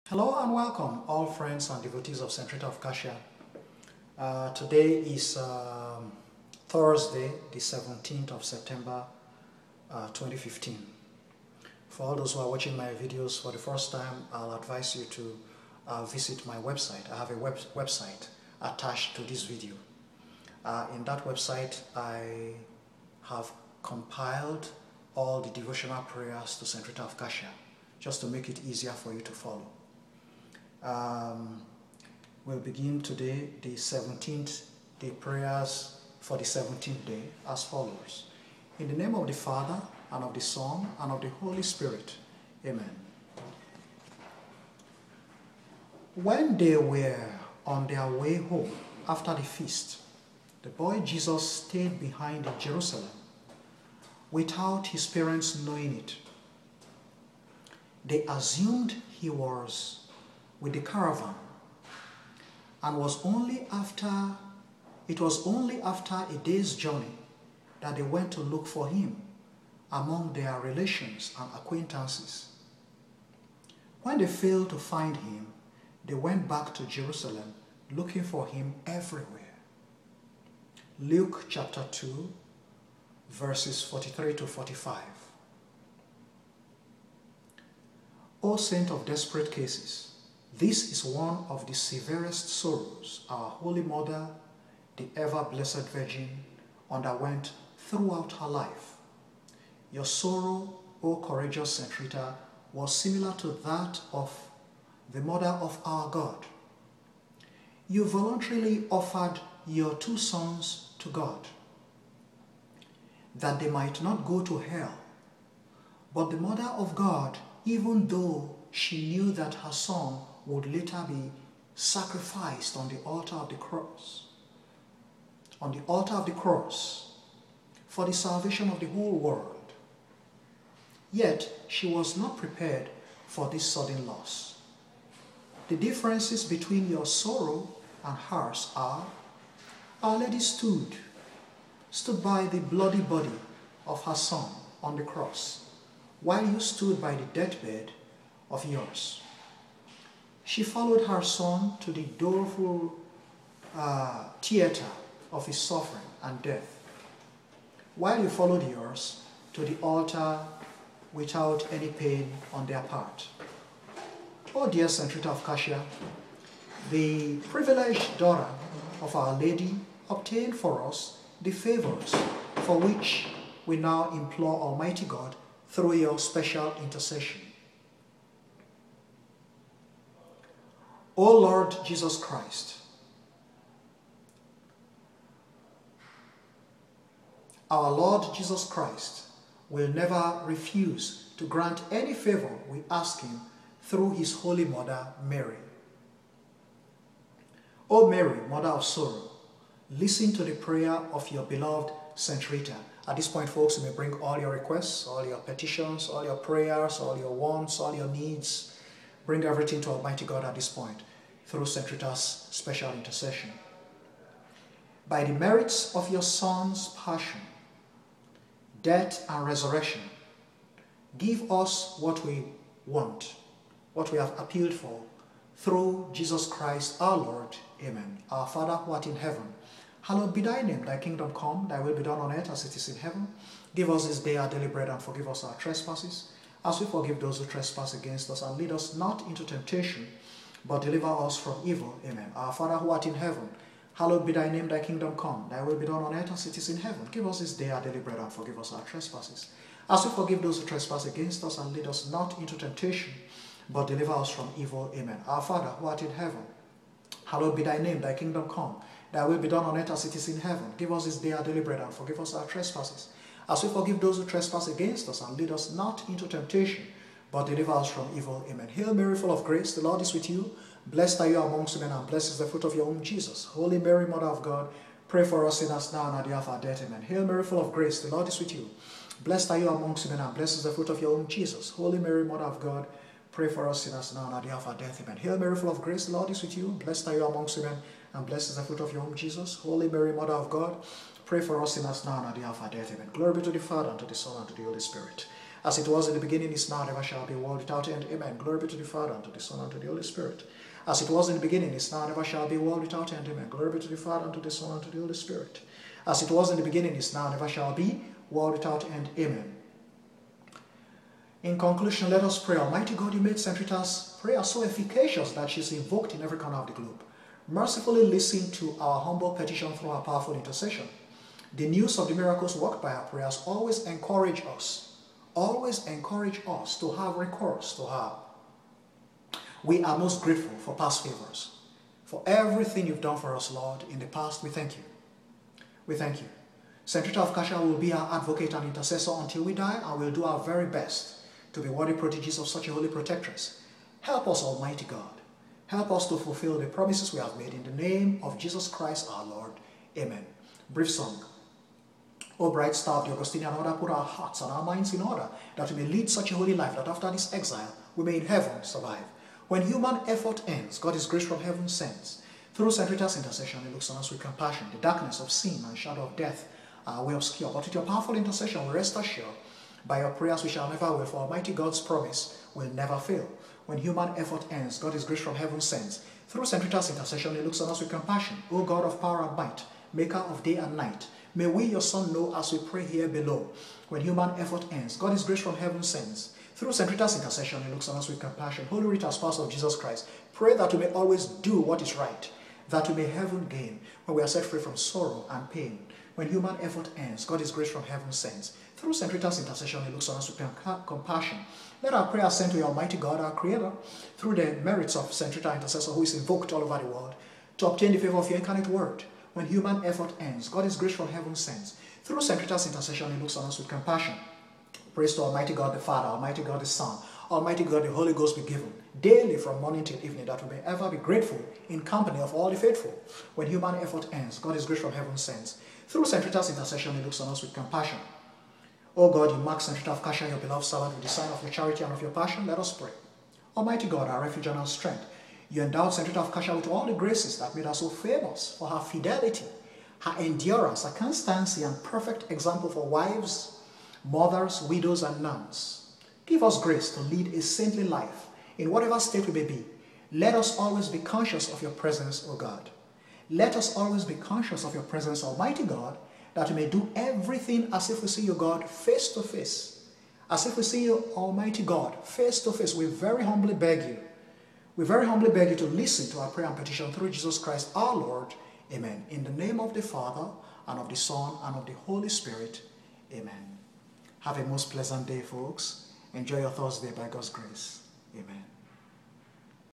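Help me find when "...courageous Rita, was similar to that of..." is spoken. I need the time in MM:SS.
01:41.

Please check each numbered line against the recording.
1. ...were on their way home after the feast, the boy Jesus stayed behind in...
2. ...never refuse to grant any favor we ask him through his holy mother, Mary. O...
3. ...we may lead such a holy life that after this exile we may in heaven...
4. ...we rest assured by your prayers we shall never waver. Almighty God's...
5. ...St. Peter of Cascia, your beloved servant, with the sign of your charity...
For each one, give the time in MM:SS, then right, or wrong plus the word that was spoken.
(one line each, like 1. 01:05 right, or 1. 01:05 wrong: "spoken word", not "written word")
1. 00:46 right
2. 03:09 right
3. 05:55 right
4. 06:08 right
5. 07:09 right.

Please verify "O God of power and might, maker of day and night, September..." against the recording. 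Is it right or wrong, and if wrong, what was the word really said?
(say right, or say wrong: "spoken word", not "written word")
wrong: "May", not "September".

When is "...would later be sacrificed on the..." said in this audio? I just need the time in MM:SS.
02:00.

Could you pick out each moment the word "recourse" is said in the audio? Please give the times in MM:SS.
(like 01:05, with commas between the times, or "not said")
05:27.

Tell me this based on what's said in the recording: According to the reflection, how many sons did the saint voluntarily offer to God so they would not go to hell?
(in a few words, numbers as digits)
2.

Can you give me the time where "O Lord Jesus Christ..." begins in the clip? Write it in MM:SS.
03:01.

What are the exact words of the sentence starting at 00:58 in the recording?
They assumed he was with the caravan.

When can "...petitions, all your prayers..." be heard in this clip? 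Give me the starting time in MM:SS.
03:25.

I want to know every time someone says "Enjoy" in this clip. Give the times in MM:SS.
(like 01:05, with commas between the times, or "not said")
07:56.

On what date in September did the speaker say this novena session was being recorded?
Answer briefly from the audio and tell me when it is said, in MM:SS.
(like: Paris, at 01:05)
17 September 2015, at 00:07.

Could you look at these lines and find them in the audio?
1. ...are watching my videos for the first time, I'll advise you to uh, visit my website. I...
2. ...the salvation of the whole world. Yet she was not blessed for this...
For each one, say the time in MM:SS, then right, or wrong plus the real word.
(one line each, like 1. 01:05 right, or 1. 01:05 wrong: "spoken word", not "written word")
1. 00:12 right
2. 02:08 wrong: "prepared", not "blessed".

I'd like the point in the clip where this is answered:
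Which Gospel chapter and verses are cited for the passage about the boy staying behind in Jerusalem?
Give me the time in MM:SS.
01:20.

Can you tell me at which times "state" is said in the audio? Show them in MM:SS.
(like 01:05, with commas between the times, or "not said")
07:29.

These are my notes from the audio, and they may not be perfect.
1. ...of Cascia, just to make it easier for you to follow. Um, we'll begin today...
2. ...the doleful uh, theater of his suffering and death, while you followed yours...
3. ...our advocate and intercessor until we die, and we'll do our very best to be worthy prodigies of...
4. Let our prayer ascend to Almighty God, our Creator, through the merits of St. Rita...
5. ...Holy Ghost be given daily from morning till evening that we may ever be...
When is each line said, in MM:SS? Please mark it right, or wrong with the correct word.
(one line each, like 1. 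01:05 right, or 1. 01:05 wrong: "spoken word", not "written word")
1. 00:27 right
2. 02:31 right
3. 05:37 right
4. 06:41 right
5. 06:57 right.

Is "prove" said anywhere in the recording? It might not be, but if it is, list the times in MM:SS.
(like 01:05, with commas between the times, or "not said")
not said.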